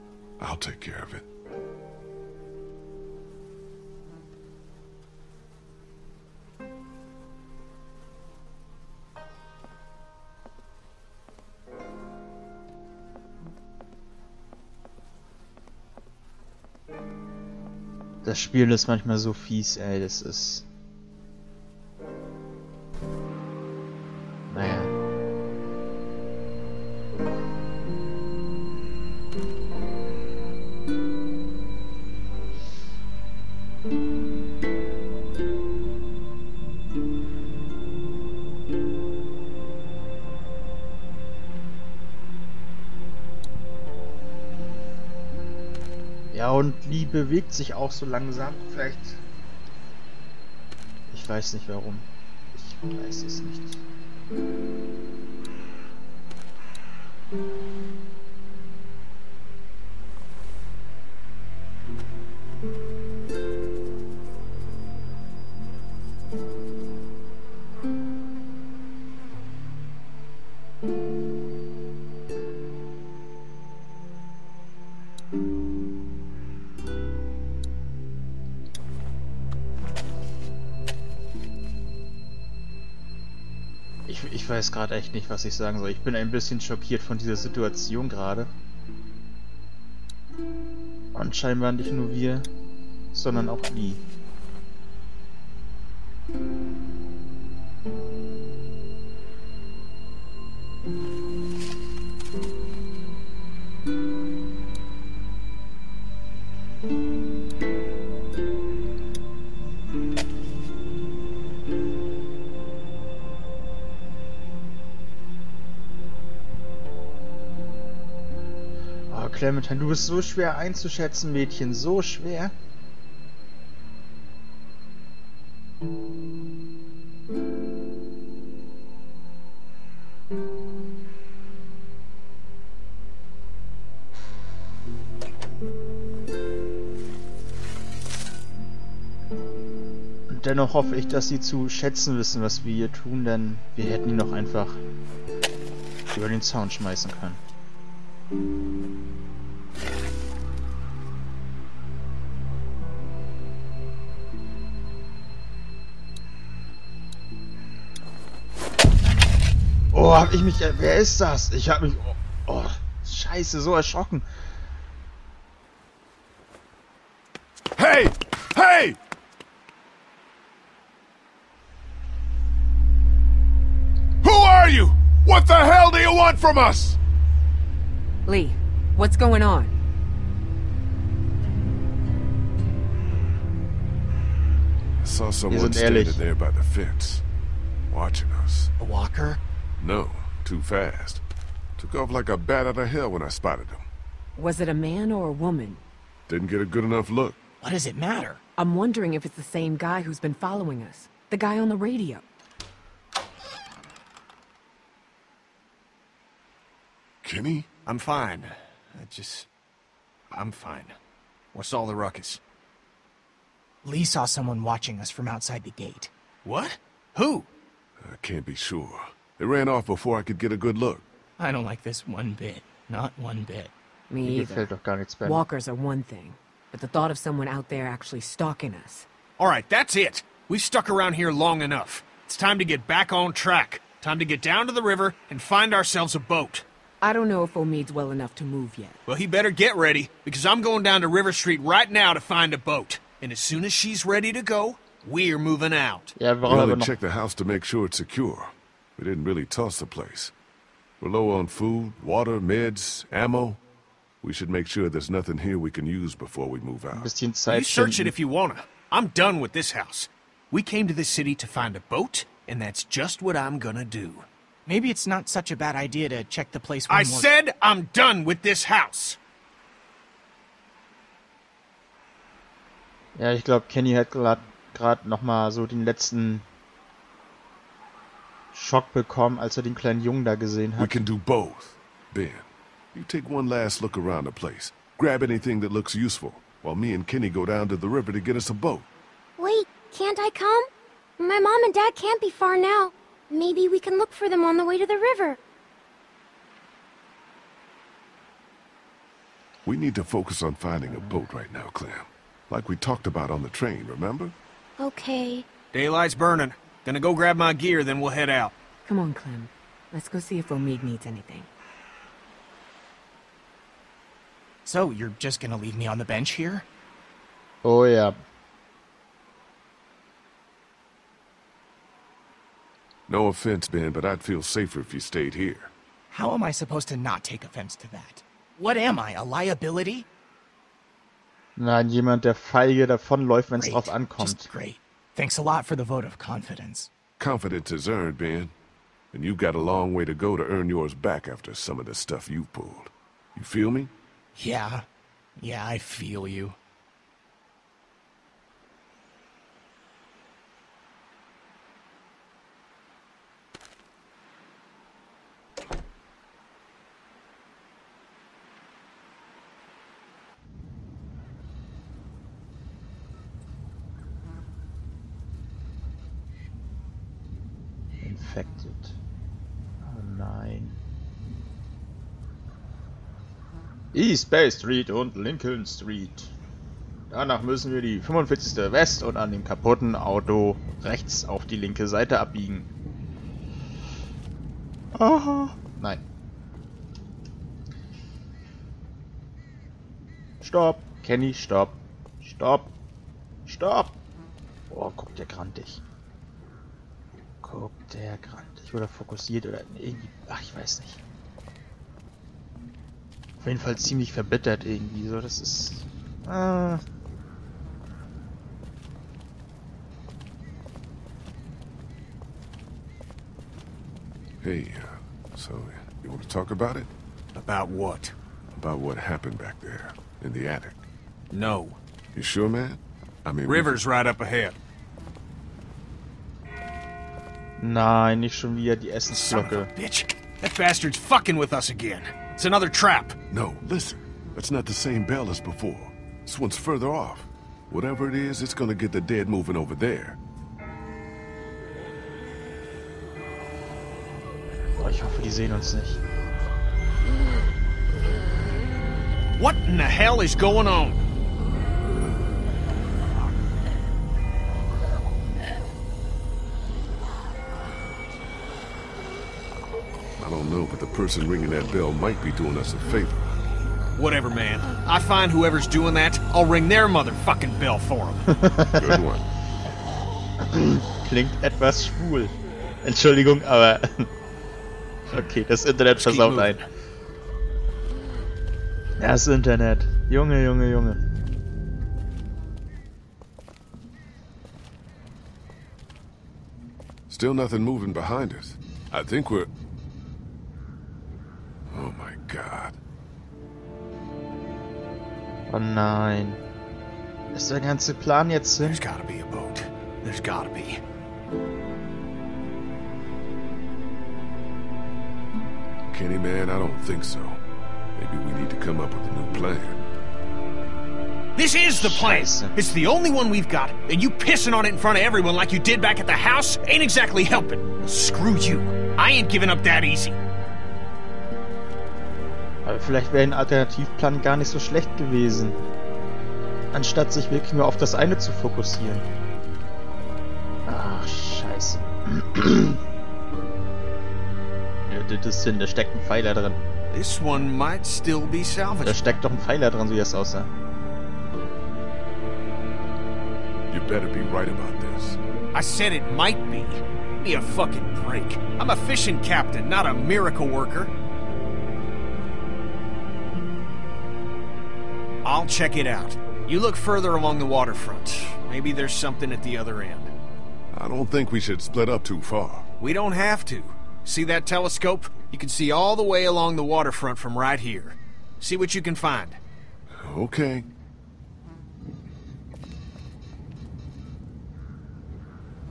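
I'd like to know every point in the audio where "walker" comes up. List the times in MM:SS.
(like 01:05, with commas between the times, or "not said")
03:08, 03:45.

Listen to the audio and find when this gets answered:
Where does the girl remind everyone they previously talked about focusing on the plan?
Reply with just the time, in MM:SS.
05:03.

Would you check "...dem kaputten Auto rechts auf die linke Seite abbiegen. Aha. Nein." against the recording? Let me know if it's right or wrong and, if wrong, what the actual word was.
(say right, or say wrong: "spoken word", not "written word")
right.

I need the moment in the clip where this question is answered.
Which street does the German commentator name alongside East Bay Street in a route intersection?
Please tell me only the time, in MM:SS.
06:15.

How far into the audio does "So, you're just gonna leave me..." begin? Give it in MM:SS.
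05:14.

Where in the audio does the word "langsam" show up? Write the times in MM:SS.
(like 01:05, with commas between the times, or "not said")
00:48.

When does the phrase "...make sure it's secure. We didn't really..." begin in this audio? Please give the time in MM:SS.
04:07.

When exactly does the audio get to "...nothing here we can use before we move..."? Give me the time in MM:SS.
04:15.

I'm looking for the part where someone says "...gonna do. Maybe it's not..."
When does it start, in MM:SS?
04:23.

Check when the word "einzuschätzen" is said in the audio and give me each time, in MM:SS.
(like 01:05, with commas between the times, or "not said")
02:00.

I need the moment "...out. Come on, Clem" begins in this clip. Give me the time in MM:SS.
05:08.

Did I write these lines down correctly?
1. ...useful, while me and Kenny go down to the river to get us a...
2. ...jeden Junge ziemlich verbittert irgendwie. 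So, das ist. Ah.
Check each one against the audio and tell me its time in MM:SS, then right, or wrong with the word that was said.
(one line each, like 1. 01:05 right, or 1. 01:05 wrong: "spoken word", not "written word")
1. 04:45 right
2. 06:43 wrong: "Fall", not "Junge".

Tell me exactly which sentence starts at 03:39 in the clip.
They ran off before I could get a good look.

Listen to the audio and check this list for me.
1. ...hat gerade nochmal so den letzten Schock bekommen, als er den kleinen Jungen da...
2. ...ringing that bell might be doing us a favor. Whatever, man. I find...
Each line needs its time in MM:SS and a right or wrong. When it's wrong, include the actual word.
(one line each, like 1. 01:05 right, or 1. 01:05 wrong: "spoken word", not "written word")
1. 04:33 right
2. 07:41 right.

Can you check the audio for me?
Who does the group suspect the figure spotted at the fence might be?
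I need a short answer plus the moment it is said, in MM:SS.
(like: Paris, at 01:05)
The guy on the radio, at 03:21.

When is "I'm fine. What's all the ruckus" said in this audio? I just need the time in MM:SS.
03:30.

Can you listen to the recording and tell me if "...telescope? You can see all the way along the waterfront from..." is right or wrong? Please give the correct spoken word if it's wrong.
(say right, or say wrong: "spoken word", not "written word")
right.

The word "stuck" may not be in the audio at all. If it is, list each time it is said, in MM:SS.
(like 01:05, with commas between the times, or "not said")
03:50.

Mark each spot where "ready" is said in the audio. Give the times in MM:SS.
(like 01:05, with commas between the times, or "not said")
03:59, 04:04.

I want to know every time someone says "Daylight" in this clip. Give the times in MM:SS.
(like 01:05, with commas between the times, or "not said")
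05:05.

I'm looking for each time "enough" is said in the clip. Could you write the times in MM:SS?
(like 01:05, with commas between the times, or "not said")
03:16, 03:51, 03:58.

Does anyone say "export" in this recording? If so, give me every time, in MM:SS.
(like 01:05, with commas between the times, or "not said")
not said.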